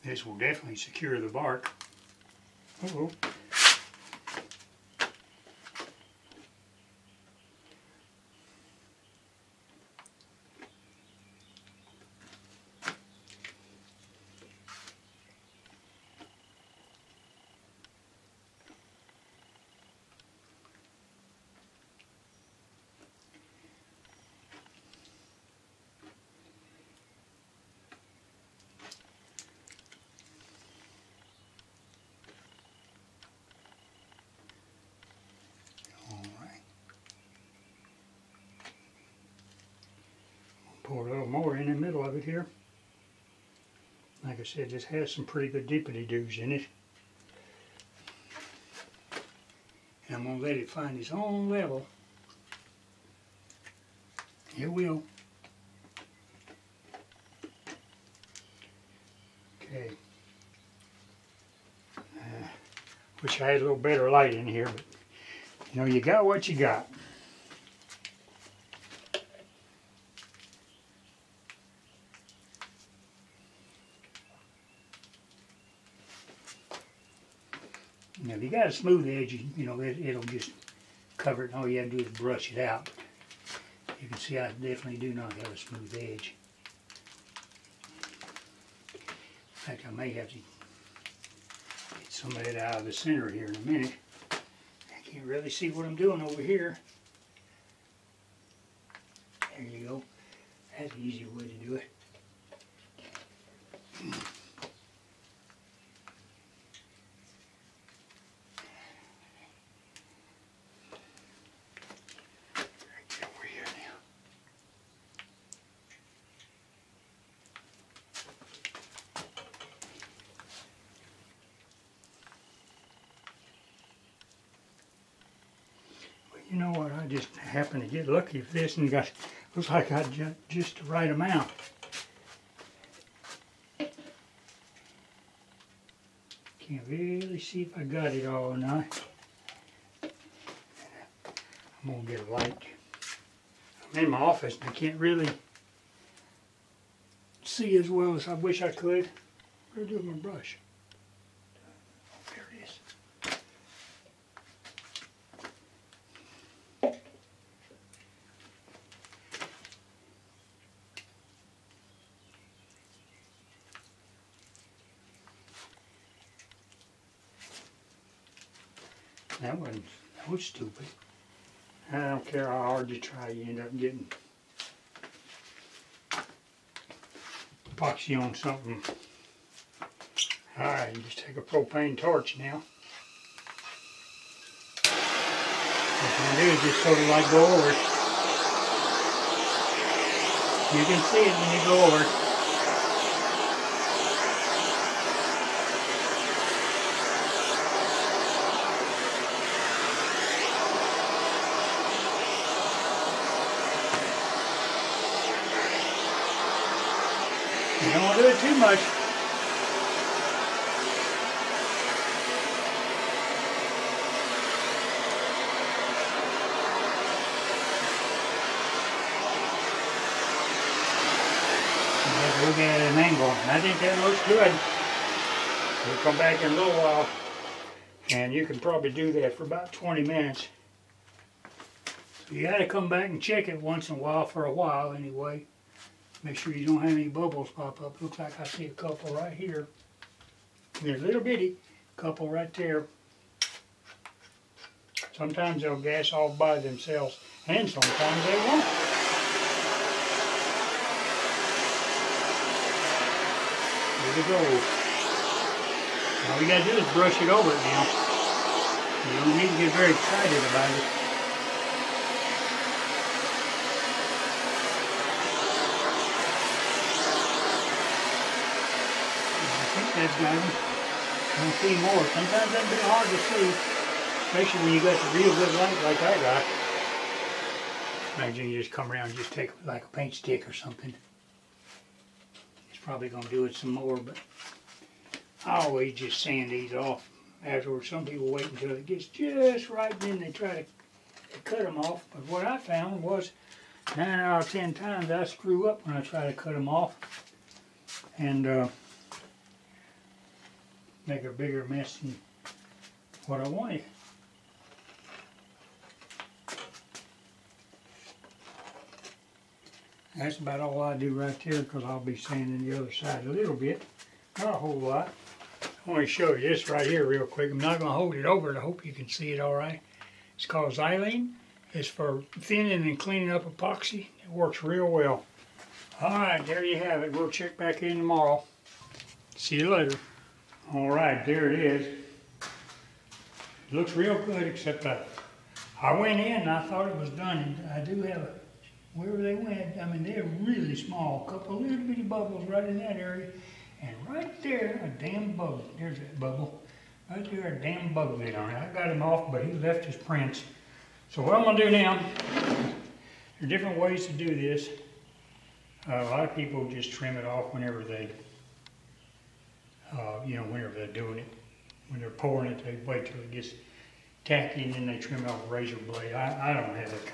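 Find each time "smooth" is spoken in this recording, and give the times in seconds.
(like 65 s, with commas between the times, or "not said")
78 s, 85 s.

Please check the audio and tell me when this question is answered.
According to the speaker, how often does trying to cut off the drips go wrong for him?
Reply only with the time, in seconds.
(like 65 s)
293 s.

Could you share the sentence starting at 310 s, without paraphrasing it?
That's about all I do right there because I'll be sanding the other side a little bit.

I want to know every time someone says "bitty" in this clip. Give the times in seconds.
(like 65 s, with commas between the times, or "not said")
241 s, 341 s.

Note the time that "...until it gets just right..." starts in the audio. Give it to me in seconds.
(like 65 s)
288 s.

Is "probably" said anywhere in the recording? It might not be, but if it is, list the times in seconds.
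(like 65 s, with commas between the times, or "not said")
228 s, 282 s.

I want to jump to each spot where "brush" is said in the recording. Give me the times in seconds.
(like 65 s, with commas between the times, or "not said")
82 s, 150 s, 256 s.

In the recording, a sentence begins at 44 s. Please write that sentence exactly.
Like I said, this has some pretty good deepity doos in it.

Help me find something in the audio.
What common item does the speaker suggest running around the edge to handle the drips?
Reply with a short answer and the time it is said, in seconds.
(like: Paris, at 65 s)
paint stick, at 279 s.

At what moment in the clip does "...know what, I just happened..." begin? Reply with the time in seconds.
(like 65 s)
126 s.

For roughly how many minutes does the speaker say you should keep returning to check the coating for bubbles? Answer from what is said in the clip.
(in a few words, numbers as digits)
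20 minutes.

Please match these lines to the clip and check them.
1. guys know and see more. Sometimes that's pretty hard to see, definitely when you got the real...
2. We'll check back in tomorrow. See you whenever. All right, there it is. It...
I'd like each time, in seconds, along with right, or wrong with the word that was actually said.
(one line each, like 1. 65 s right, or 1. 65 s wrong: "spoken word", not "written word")
1. 270 s wrong: "especially", not "definitely"
2. 327 s wrong: "later", not "whenever".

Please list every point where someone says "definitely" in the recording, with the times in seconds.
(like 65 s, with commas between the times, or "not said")
0 s, 84 s.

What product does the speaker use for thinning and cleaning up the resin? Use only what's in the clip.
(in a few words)
Xylene.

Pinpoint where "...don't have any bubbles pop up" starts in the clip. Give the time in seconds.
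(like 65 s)
236 s.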